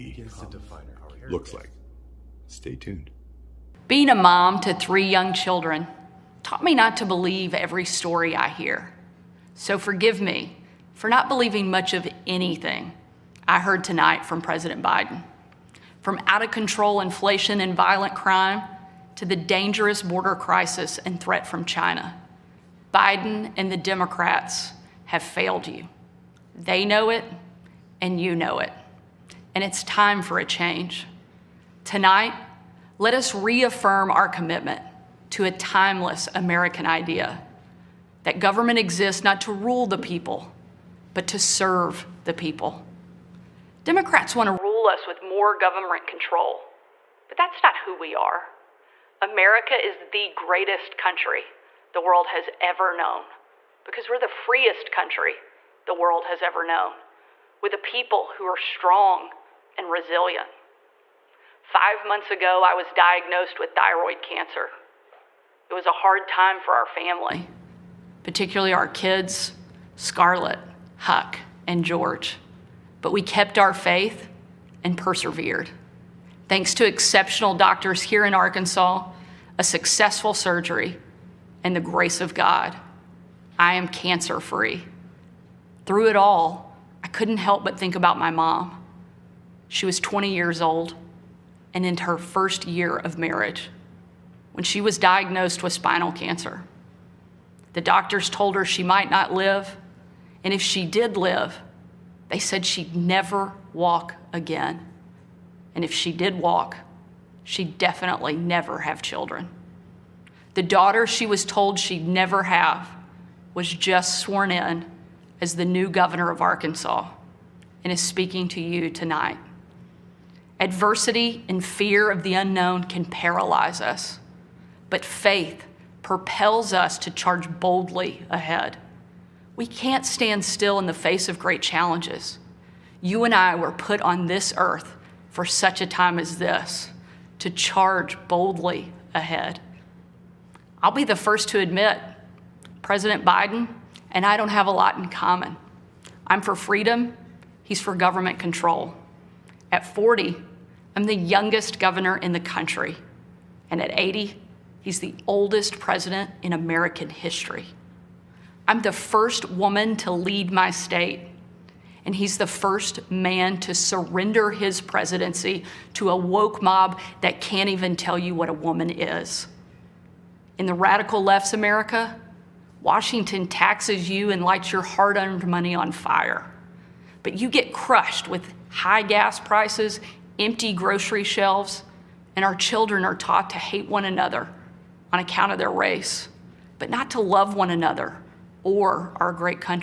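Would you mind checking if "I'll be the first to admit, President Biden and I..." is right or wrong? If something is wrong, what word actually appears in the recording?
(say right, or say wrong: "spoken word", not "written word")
right.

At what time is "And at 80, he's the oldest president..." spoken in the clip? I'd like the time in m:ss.
2:33.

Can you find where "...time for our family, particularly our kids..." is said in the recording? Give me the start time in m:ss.
1:06.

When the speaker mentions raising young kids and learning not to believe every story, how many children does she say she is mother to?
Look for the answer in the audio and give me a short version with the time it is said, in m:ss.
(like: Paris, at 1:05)
3, at 0:04.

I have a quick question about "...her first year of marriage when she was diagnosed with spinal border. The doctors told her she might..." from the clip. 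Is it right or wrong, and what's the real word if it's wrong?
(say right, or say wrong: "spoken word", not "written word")
wrong: "cancer", not "border".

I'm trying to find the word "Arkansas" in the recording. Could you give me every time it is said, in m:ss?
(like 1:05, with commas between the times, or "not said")
1:18, 1:56.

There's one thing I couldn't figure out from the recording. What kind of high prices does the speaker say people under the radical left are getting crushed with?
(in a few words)
gas prices.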